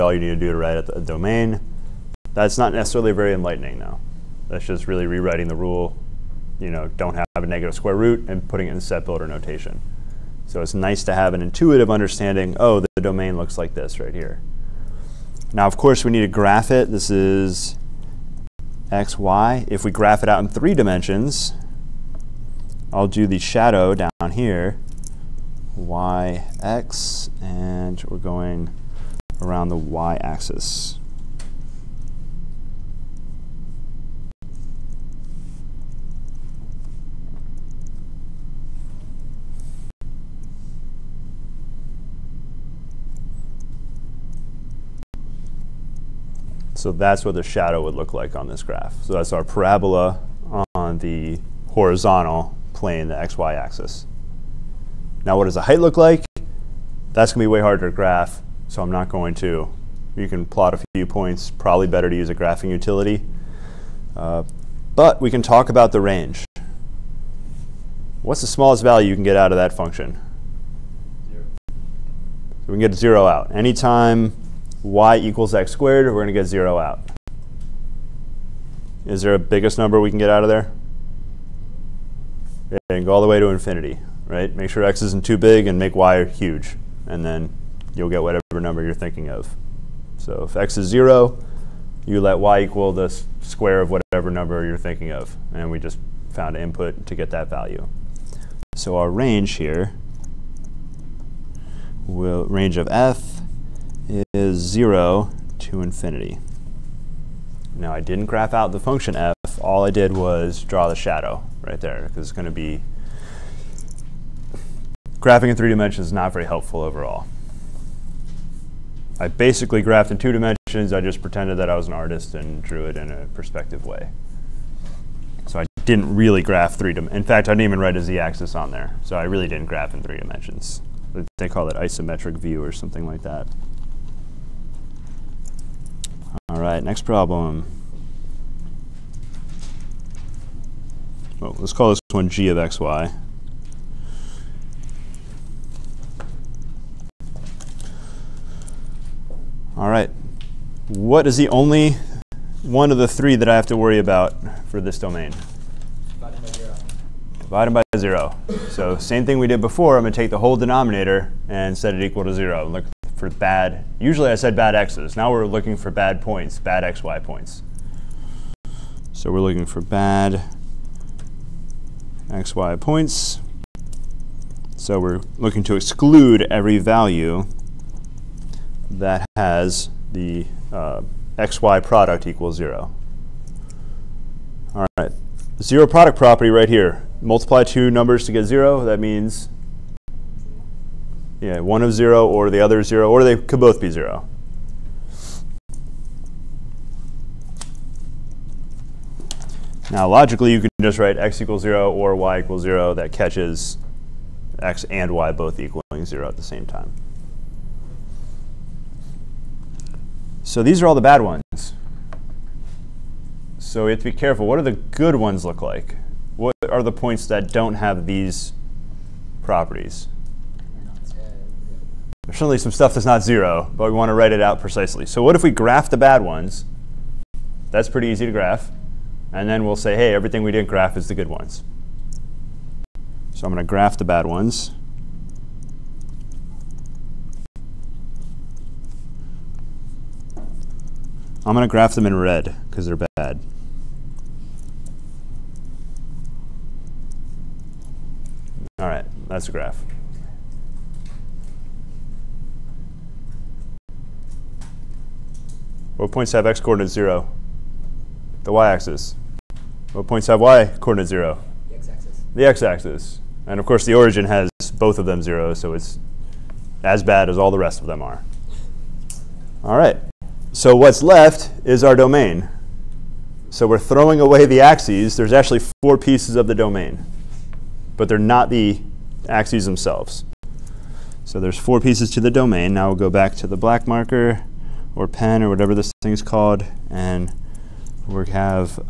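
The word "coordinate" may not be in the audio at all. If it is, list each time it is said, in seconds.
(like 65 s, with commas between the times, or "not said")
256 s, 260 s.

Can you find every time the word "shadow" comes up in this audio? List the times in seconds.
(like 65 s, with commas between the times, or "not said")
23 s, 47 s, 110 s.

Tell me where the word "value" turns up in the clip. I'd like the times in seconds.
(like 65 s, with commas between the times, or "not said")
68 s, 97 s, 176 s.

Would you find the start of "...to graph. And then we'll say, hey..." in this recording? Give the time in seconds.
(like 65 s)
228 s.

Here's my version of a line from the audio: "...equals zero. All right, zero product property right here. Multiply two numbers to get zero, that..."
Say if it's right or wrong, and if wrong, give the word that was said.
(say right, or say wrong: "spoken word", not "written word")
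right.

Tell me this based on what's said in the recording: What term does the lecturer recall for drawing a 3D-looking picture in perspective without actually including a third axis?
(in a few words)
Isometric view.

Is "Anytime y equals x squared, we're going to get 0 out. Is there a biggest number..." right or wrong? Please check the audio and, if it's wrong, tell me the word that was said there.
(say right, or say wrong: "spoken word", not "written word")
right.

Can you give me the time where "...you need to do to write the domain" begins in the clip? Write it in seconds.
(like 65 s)
0 s.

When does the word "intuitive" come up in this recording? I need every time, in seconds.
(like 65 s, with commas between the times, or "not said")
11 s.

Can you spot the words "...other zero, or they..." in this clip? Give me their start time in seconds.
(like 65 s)
192 s.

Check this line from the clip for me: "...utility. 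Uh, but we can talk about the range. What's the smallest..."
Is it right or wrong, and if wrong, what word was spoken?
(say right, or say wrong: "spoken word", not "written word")
right.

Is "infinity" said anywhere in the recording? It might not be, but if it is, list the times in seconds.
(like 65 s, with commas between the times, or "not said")
83 s, 105 s.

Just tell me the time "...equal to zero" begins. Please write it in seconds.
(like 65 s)
162 s.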